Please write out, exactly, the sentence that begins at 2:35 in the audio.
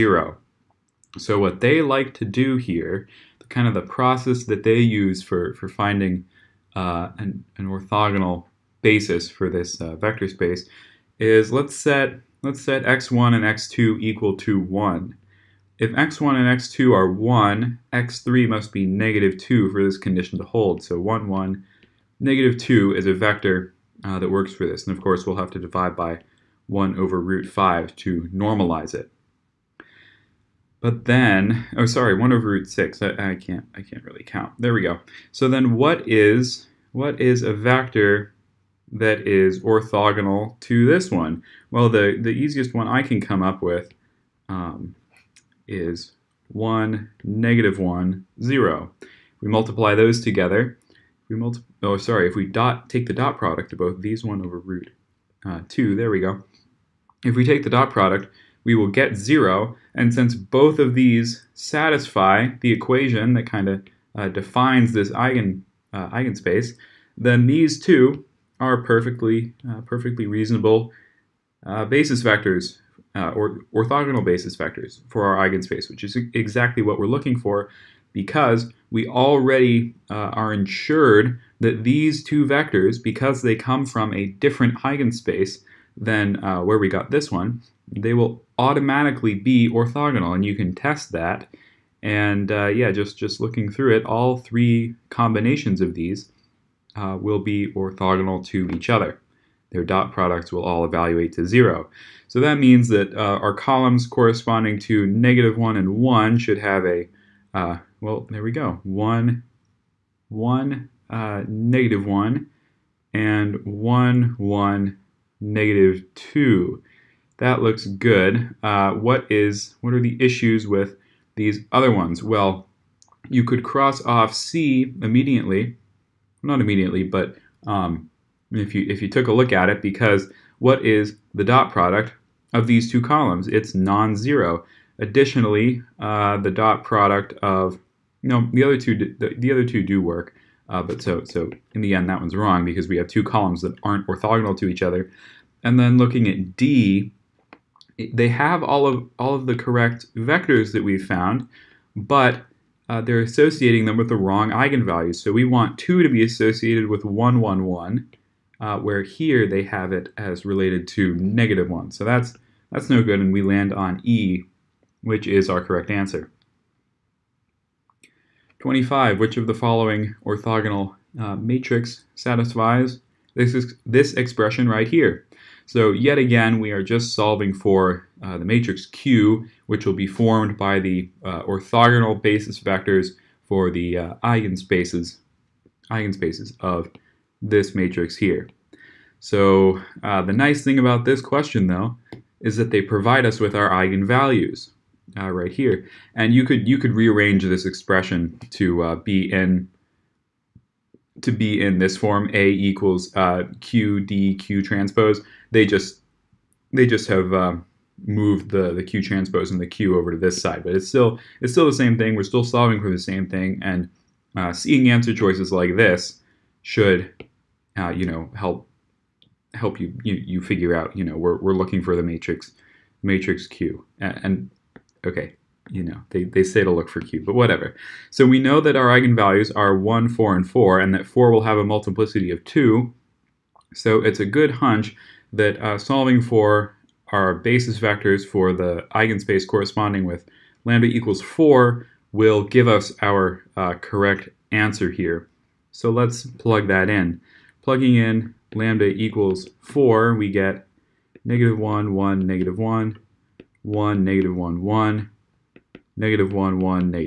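So we want 2 to be associated with 1, 1, 1, uh, where here they have it as related to negative 1.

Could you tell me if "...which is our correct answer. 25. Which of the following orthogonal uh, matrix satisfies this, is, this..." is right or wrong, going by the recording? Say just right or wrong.
right.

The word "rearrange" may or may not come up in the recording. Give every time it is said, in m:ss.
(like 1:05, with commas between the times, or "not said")
3:16.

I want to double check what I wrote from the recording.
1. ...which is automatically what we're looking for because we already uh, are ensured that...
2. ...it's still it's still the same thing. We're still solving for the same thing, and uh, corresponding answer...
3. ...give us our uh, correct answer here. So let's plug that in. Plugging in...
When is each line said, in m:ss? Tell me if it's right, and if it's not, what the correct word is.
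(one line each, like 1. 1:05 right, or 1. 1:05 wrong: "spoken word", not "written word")
1. 1:15 wrong: "exactly", not "automatically"
2. 3:30 wrong: "seeing", not "corresponding"
3. 4:02 right.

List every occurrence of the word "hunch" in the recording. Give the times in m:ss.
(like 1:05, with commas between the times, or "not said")
3:54.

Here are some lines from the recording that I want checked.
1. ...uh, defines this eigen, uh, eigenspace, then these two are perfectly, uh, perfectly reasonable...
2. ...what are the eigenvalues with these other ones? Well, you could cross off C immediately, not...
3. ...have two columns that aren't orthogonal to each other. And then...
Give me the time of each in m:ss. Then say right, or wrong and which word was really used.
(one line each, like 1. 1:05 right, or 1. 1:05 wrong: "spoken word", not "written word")
1. 1:04 right
2. 1:59 wrong: "issues", not "eigenvalues"
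3. 2:22 right.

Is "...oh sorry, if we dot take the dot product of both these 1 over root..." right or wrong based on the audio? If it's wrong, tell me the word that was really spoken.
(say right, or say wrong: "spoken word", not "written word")
right.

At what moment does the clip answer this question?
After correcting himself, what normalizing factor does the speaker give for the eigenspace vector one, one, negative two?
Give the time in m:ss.
0:32.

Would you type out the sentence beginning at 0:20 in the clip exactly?
So 1, 1, negative 2 is a vector uh, that works for this.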